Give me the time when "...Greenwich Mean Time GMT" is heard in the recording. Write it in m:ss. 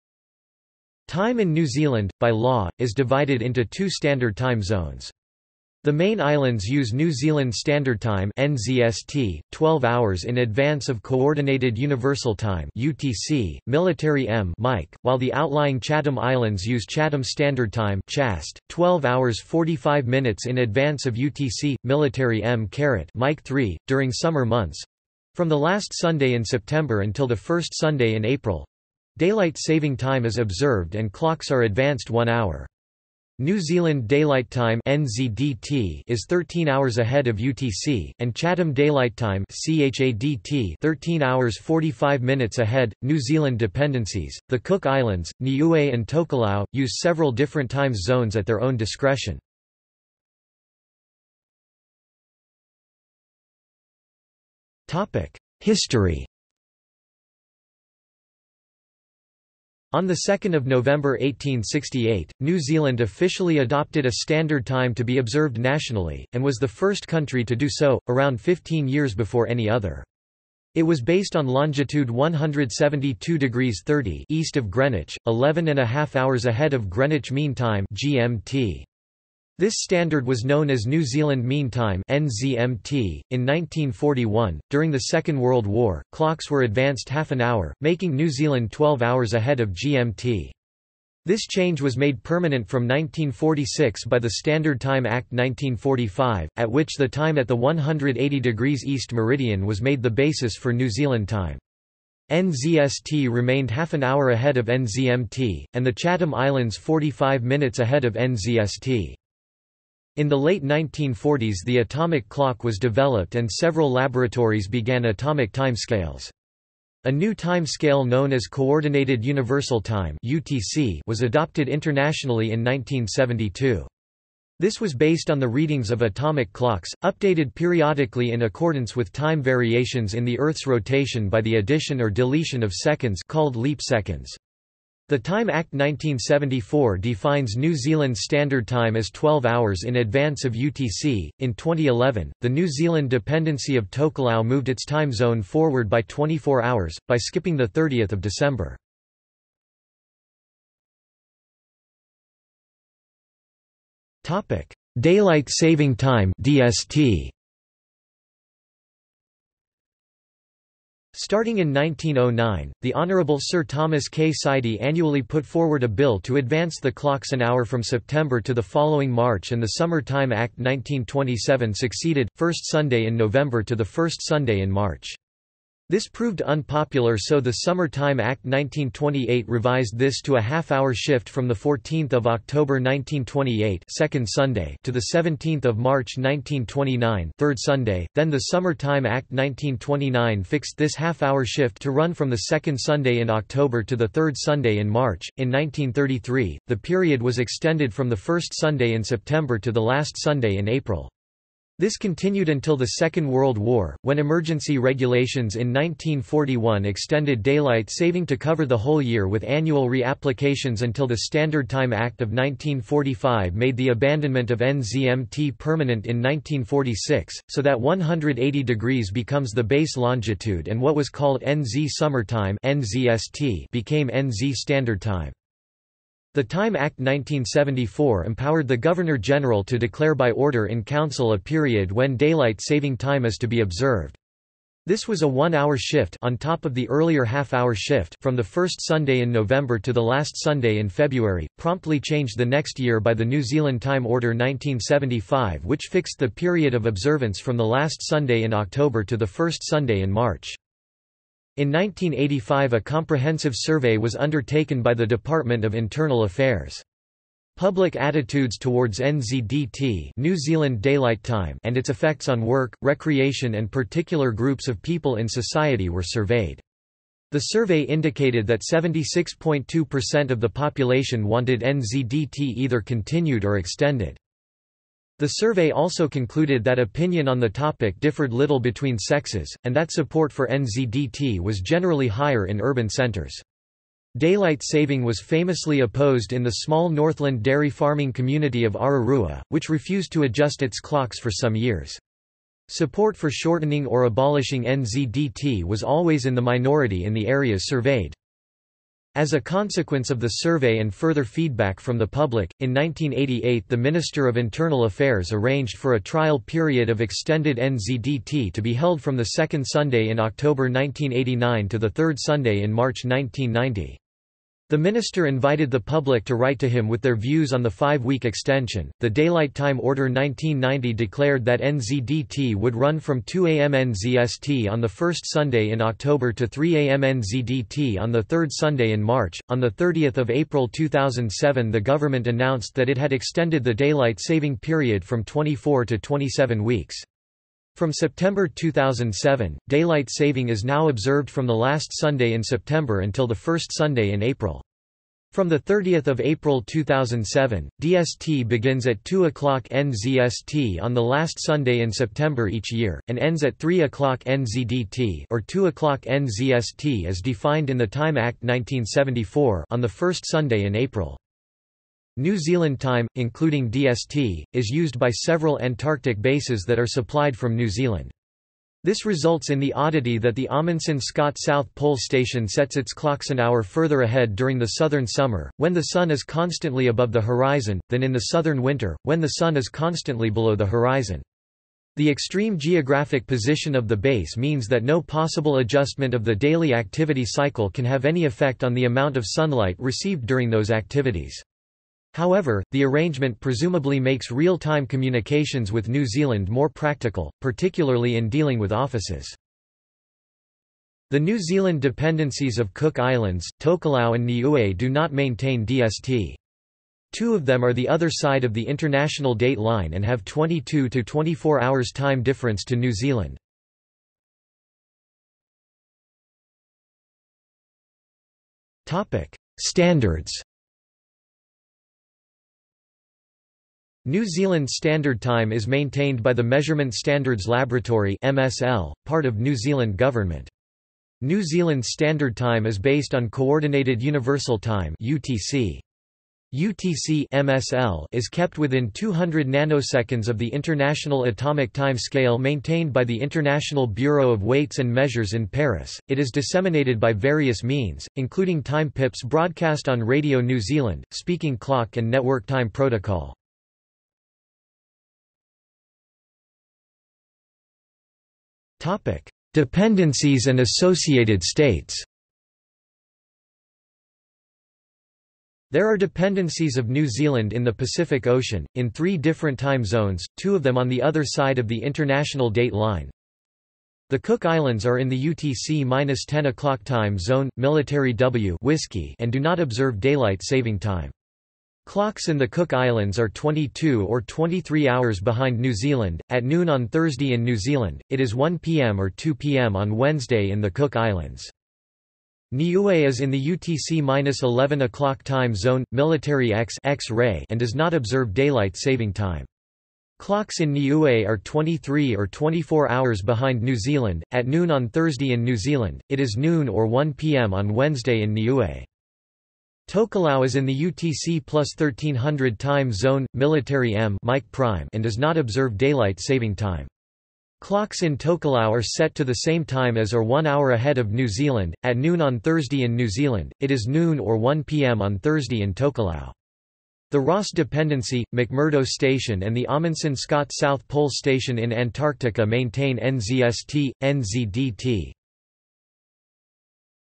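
1:16.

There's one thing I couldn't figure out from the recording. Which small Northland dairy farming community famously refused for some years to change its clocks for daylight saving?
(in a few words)
Ararua.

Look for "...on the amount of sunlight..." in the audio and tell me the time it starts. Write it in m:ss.
6:28.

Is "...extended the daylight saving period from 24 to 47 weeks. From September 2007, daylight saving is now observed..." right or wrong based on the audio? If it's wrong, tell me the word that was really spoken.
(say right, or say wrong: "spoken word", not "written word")
wrong: "27", not "47".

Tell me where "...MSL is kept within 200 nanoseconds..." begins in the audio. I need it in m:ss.
7:17.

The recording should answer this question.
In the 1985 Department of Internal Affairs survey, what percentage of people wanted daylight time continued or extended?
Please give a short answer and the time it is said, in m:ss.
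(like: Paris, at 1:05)
76.2%, at 4:28.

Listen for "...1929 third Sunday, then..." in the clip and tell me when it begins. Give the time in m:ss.
3:06.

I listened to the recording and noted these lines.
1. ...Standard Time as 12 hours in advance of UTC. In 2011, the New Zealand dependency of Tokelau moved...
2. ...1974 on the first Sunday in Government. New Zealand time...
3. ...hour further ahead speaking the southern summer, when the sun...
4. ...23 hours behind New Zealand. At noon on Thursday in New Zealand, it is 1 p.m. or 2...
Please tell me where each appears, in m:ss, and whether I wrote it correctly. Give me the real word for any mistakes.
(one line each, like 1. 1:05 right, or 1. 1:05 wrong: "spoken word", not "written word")
1. 2:18 right
2. 5:58 wrong: "April", not "Government"
3. 6:13 wrong: "during", not "speaking"
4. 8:04 right.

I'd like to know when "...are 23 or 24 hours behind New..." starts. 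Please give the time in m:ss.
8:21.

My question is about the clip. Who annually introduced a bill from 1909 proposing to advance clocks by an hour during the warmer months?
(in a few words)
Sir Thomas K. Sidey.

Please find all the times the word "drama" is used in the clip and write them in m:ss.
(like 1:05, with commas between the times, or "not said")
not said.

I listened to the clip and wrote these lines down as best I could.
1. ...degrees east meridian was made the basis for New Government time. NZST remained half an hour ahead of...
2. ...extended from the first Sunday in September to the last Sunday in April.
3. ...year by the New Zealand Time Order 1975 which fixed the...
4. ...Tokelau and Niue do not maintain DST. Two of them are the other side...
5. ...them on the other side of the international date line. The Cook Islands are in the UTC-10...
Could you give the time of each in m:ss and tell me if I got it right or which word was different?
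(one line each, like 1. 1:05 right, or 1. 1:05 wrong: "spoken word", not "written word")
1. 1:38 wrong: "Zealand", not "Government"
2. 3:17 right
3. 4:02 right
4. 6:43 right
5. 7:50 right.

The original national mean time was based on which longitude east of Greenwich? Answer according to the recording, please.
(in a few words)
172 degrees 30.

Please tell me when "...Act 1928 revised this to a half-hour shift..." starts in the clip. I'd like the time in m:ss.
2:58.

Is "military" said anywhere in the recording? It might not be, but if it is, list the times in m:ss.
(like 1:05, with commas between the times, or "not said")
0:13, 0:21, 7:57, 8:15, 8:33.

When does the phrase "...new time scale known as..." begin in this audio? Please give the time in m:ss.
1:57.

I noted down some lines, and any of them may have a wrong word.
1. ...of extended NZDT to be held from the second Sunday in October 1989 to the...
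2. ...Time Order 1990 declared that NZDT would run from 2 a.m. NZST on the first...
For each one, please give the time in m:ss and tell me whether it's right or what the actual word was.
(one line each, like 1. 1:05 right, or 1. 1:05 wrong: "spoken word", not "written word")
1. 5:06 right
2. 5:19 right.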